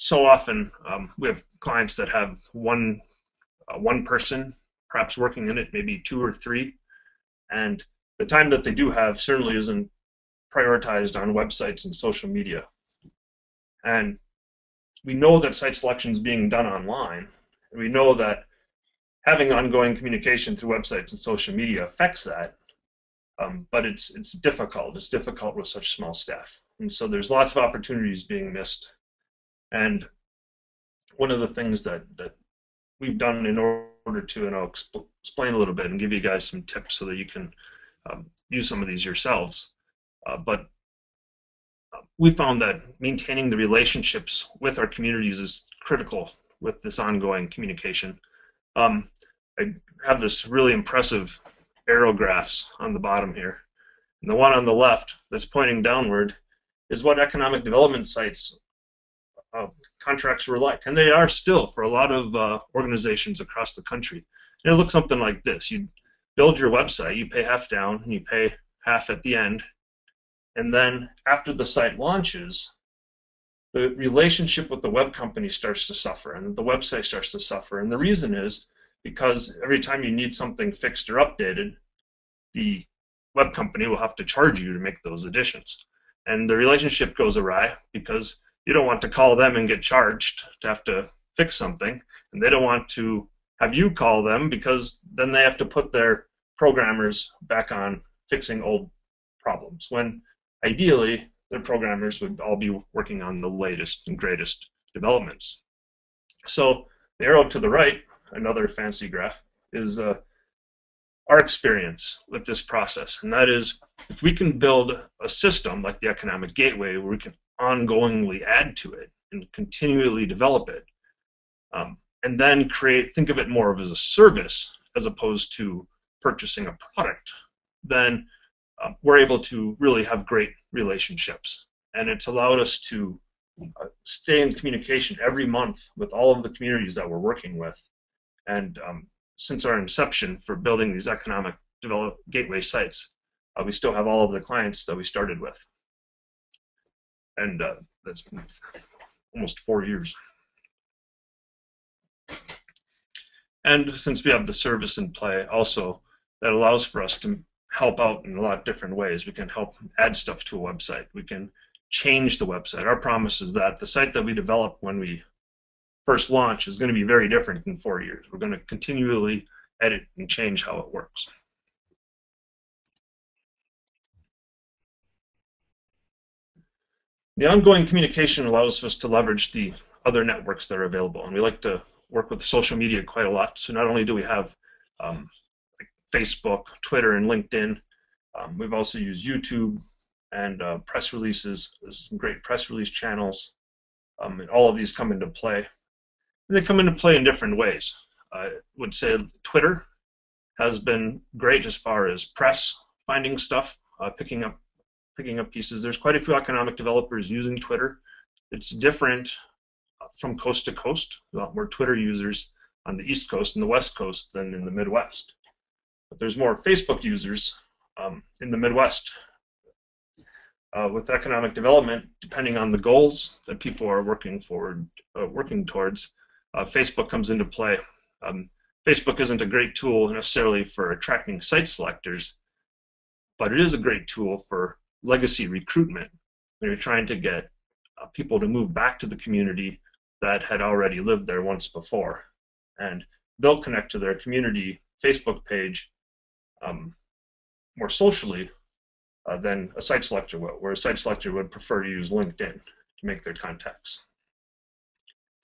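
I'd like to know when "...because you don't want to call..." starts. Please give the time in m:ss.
1:27.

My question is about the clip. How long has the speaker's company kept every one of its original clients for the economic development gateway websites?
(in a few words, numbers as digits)
almost 4 years.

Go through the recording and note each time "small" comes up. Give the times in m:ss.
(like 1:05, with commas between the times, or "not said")
0:25.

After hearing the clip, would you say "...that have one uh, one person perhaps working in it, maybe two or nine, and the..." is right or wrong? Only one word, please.
wrong.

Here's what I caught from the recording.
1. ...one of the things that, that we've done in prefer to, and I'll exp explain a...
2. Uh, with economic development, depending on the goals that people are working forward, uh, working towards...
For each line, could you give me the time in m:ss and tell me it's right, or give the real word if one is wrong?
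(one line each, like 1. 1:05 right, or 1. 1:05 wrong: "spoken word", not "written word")
1. 0:31 wrong: "order", not "prefer"
2. 3:40 right.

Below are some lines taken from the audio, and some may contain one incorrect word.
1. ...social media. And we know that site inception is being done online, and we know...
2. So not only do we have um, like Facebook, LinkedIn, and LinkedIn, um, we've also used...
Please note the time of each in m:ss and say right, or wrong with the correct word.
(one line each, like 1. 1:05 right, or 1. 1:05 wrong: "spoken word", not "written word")
1. 0:11 wrong: "selection", not "inception"
2. 3:03 wrong: "Twitter", not "LinkedIn".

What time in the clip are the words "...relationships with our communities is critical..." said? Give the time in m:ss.
0:43.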